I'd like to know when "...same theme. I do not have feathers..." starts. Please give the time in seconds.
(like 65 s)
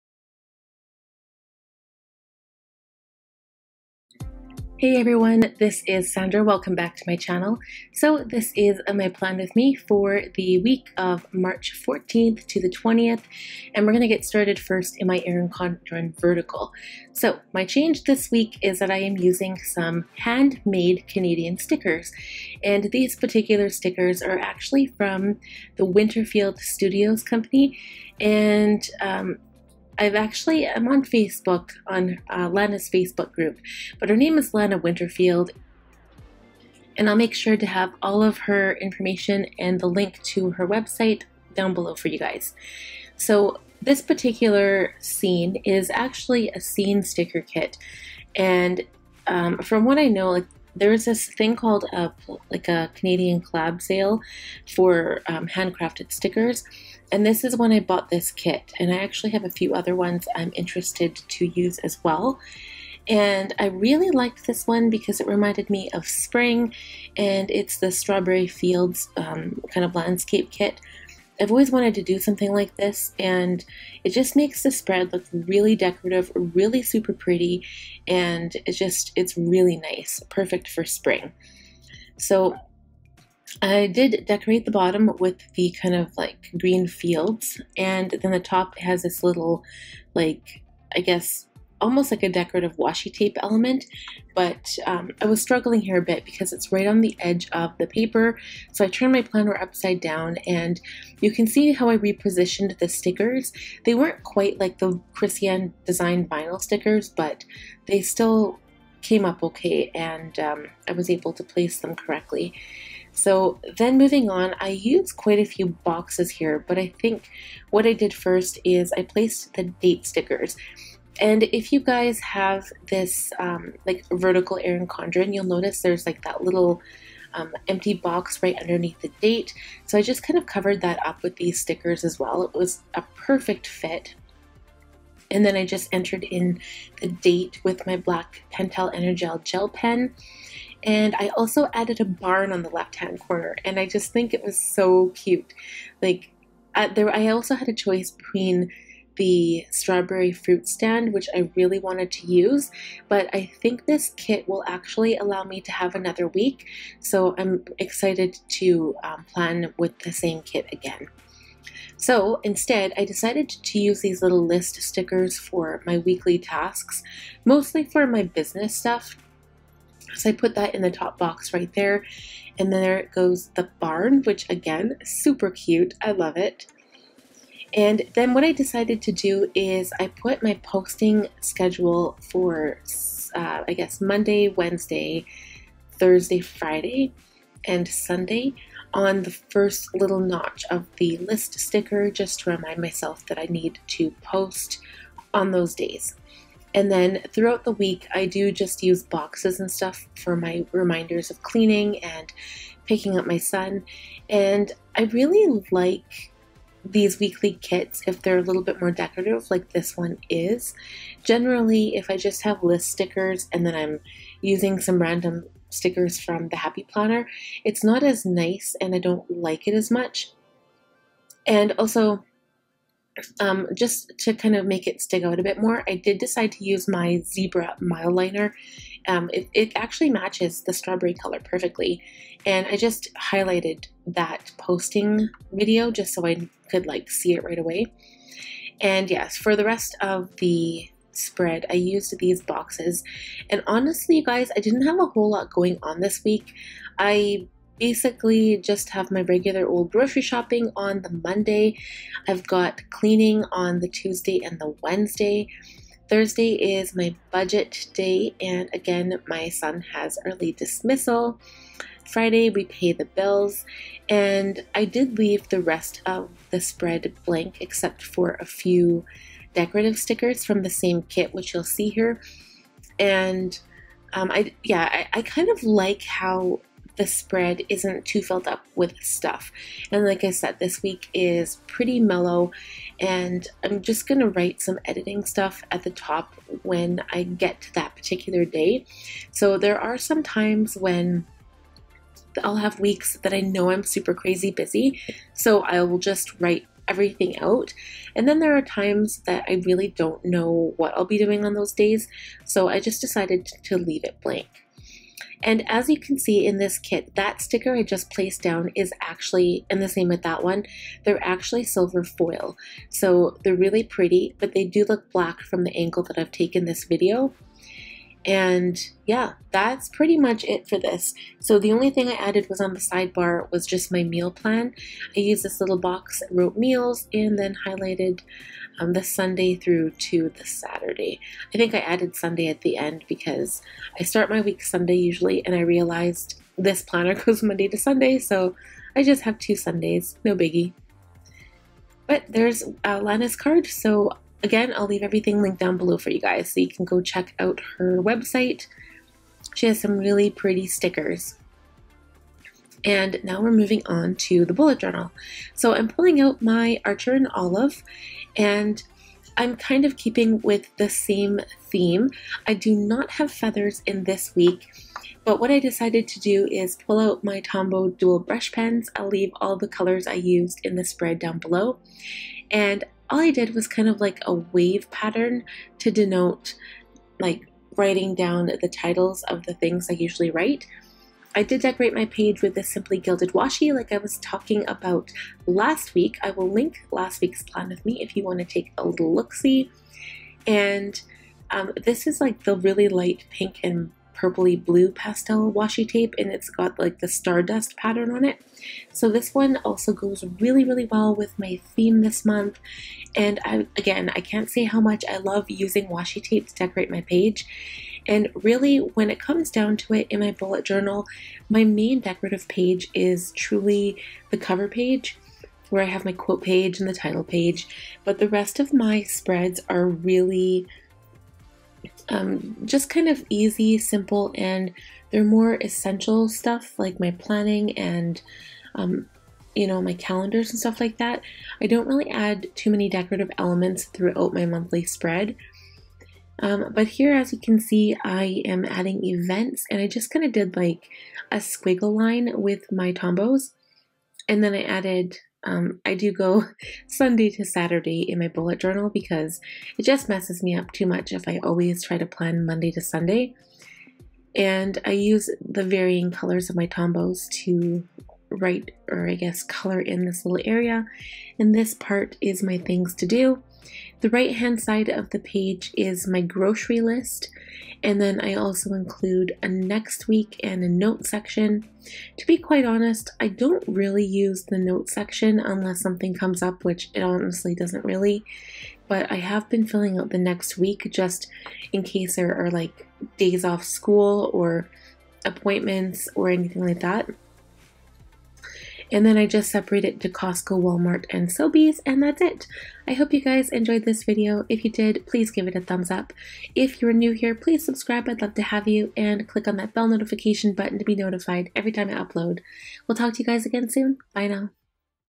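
360 s.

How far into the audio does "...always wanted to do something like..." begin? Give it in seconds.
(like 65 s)
71 s.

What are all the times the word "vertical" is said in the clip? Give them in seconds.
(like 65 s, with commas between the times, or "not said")
16 s, 124 s.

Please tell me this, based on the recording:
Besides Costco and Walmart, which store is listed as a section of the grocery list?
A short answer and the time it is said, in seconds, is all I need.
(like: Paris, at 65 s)
Sobeys, at 491 s.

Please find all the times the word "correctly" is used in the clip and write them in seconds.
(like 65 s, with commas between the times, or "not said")
111 s.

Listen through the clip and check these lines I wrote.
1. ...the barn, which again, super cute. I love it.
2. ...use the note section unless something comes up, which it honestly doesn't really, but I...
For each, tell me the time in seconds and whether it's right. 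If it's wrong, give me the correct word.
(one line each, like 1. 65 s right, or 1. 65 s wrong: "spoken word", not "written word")
1. 173 s right
2. 474 s right.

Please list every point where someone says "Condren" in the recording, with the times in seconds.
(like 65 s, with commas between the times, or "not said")
15 s, 124 s.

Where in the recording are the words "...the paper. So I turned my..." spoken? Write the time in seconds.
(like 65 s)
97 s.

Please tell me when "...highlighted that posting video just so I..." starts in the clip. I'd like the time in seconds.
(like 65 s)
233 s.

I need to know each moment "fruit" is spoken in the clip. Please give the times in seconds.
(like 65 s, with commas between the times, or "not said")
150 s.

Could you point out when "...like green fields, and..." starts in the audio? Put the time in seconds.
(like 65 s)
86 s.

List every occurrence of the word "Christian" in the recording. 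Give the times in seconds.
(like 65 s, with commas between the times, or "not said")
105 s.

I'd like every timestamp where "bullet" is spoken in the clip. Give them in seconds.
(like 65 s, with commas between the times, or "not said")
354 s, 410 s, 448 s.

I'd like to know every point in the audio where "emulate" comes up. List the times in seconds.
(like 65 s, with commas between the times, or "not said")
not said.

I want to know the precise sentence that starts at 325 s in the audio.
I used this little box wrote meals and then highlighted um, the Sunday through to the Saturday.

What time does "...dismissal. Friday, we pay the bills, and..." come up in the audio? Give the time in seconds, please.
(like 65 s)
260 s.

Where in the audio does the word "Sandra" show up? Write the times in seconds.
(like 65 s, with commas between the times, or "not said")
6 s.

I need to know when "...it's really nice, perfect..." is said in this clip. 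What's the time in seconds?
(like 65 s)
79 s.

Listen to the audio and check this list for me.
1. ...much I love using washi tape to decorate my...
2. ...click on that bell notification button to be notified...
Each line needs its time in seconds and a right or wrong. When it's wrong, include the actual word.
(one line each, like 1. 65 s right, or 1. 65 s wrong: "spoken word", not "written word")
1. 404 s right
2. 499 s right.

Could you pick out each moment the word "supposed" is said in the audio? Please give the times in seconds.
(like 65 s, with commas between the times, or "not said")
not said.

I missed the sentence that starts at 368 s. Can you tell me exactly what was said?
I'll leave all the colors I used in the spread down below.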